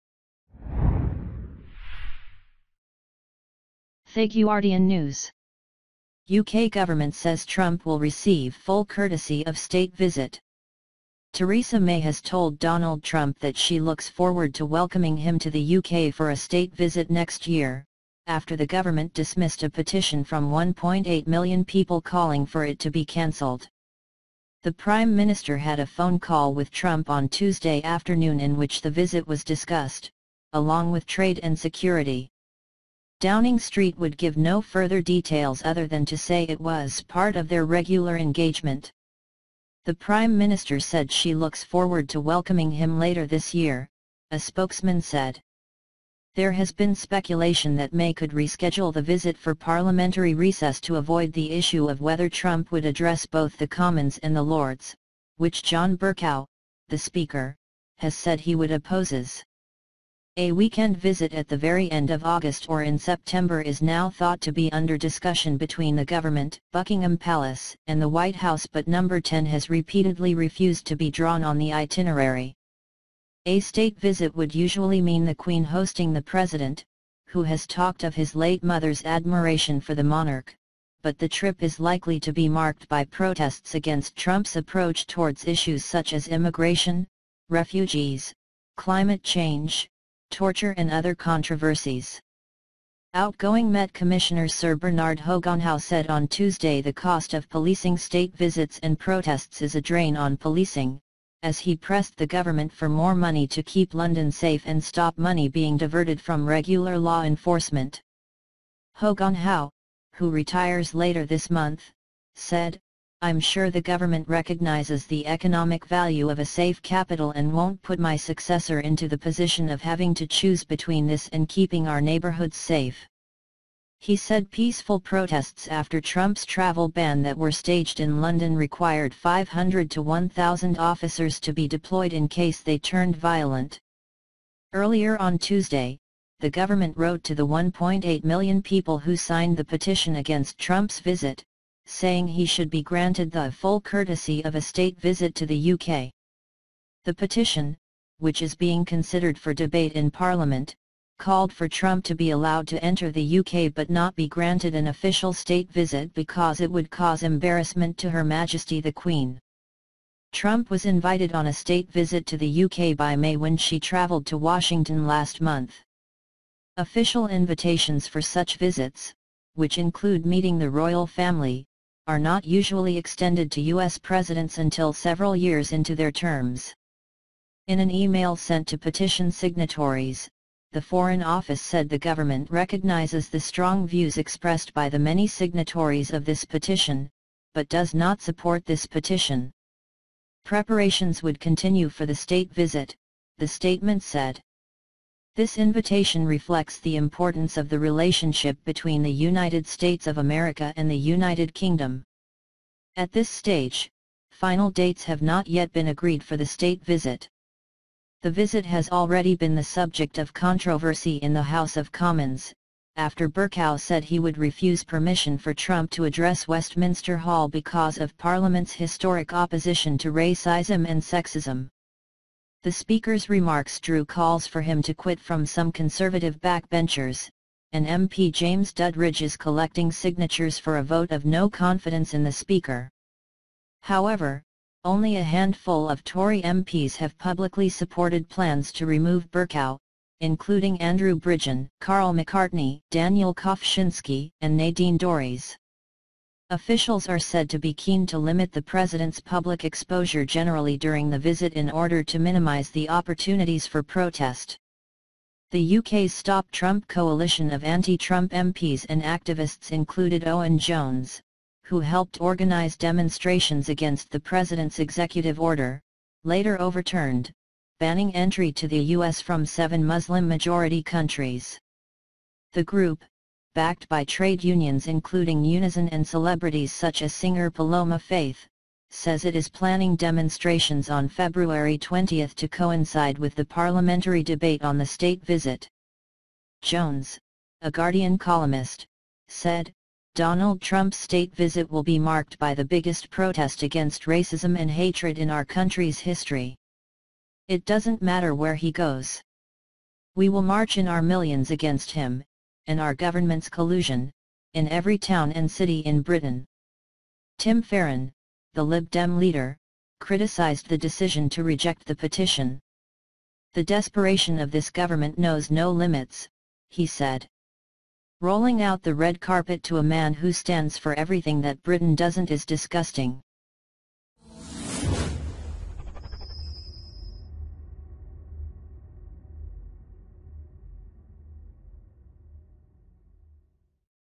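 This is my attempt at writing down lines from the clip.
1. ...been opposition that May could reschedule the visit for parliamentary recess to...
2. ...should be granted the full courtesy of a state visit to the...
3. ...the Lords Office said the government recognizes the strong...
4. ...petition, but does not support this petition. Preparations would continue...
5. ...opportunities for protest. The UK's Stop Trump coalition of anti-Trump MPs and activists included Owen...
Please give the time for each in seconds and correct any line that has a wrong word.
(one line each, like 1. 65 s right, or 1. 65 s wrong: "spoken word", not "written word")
1. 46 s wrong: "speculation", not "opposition"
2. 142 s right
3. 180 s wrong: "Foreign", not "Lords"
4. 186 s right
5. 252 s right.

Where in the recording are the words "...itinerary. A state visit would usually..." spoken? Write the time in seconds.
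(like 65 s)
71 s.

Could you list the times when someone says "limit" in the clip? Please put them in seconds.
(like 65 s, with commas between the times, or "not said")
248 s, 315 s.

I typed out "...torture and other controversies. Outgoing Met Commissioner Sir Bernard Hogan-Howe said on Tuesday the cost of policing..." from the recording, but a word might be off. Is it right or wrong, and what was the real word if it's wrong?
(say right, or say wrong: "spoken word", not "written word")
right.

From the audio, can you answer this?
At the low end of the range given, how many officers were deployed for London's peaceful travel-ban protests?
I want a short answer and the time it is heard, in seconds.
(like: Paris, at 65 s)
500, at 129 s.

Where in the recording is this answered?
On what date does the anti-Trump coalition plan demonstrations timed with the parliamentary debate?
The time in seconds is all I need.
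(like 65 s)
281 s.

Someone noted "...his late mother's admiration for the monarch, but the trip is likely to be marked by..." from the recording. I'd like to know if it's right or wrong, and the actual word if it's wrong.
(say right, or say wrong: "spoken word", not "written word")
right.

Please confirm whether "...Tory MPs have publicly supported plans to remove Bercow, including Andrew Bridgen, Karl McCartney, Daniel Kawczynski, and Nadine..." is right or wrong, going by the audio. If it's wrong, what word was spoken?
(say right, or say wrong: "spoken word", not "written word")
right.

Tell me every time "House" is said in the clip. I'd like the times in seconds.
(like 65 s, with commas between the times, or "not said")
68 s, 211 s.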